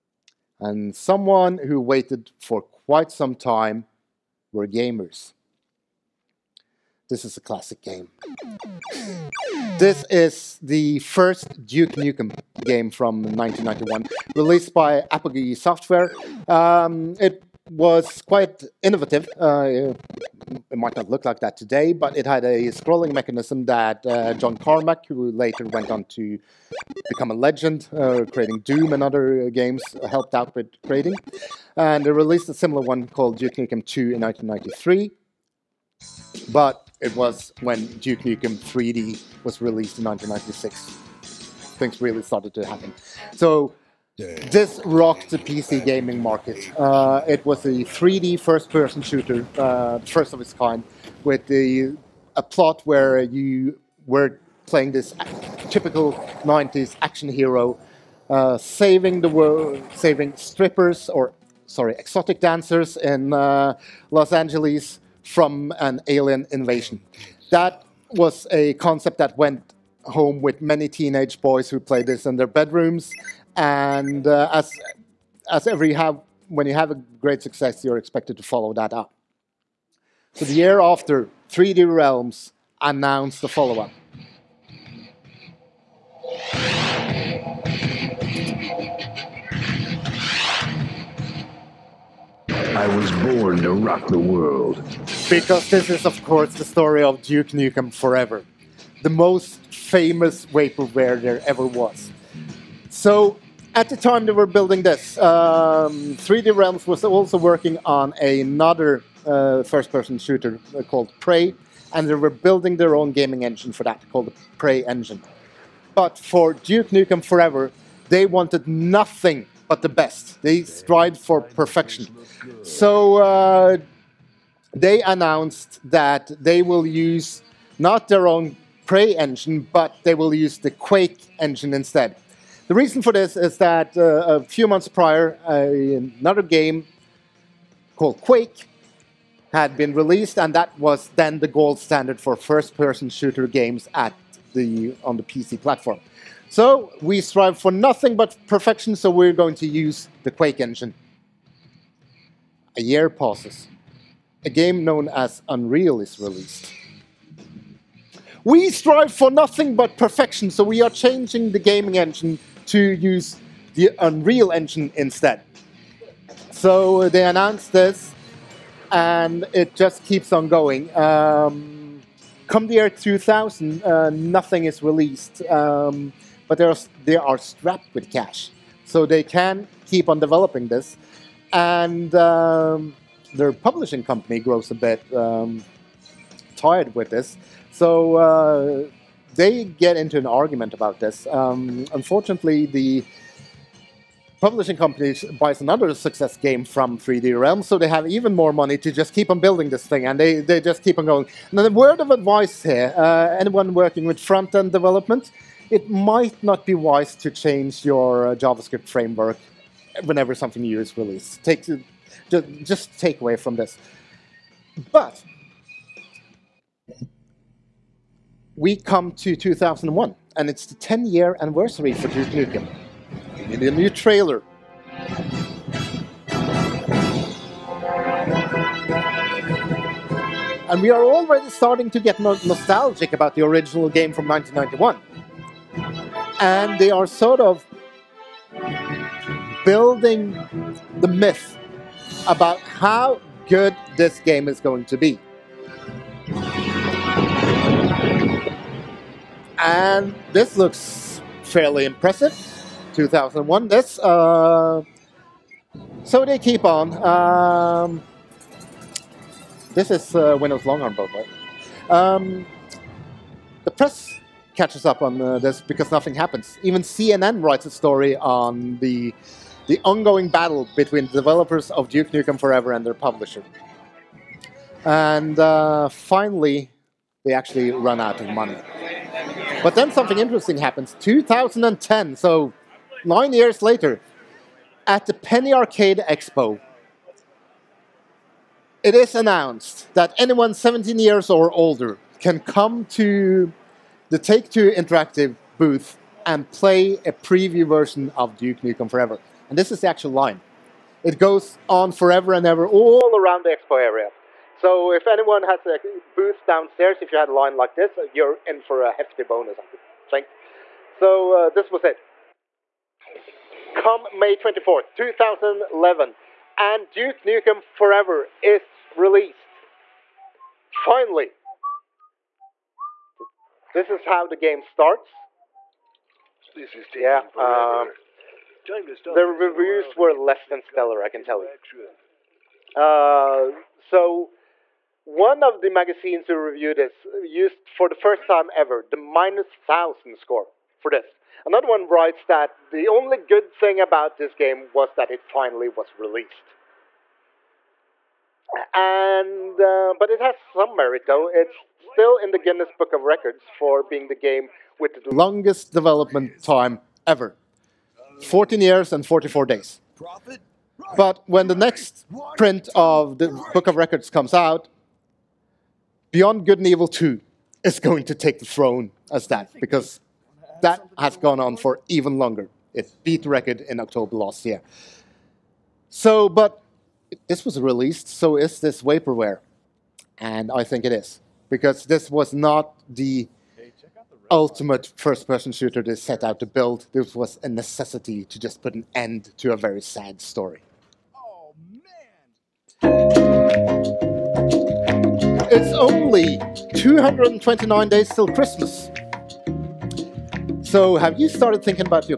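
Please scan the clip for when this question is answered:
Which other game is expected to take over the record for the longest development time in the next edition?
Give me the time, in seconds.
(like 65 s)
366 s.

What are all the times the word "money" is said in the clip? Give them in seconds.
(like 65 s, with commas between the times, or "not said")
198 s, 278 s.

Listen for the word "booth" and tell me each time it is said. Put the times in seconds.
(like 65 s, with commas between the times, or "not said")
295 s, 306 s.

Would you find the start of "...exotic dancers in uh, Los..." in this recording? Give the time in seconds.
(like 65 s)
61 s.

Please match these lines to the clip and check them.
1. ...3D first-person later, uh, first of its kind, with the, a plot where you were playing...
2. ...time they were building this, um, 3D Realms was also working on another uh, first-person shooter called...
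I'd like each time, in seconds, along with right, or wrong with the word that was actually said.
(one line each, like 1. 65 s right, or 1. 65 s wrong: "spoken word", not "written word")
1. 47 s wrong: "shooter", not "later"
2. 103 s right.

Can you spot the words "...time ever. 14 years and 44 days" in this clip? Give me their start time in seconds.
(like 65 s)
356 s.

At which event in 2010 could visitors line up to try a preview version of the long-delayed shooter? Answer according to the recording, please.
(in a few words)
Penny Arcade Expo.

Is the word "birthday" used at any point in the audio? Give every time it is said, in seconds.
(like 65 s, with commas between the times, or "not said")
not said.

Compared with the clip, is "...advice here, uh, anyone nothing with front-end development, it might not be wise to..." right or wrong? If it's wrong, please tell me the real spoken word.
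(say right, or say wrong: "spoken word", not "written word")
wrong: "working", not "nothing".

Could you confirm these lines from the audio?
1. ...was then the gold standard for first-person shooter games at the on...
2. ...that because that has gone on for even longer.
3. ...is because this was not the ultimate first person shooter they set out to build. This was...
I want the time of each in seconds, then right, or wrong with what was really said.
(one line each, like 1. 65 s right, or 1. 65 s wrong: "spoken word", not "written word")
1. 140 s right
2. 369 s right
3. 380 s right.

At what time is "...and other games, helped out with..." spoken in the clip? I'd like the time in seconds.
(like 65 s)
28 s.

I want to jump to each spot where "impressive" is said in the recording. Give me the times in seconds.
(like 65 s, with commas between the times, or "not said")
251 s.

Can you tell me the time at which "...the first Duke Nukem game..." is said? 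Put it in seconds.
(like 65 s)
10 s.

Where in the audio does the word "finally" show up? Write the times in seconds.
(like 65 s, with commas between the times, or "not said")
275 s, 320 s, 345 s.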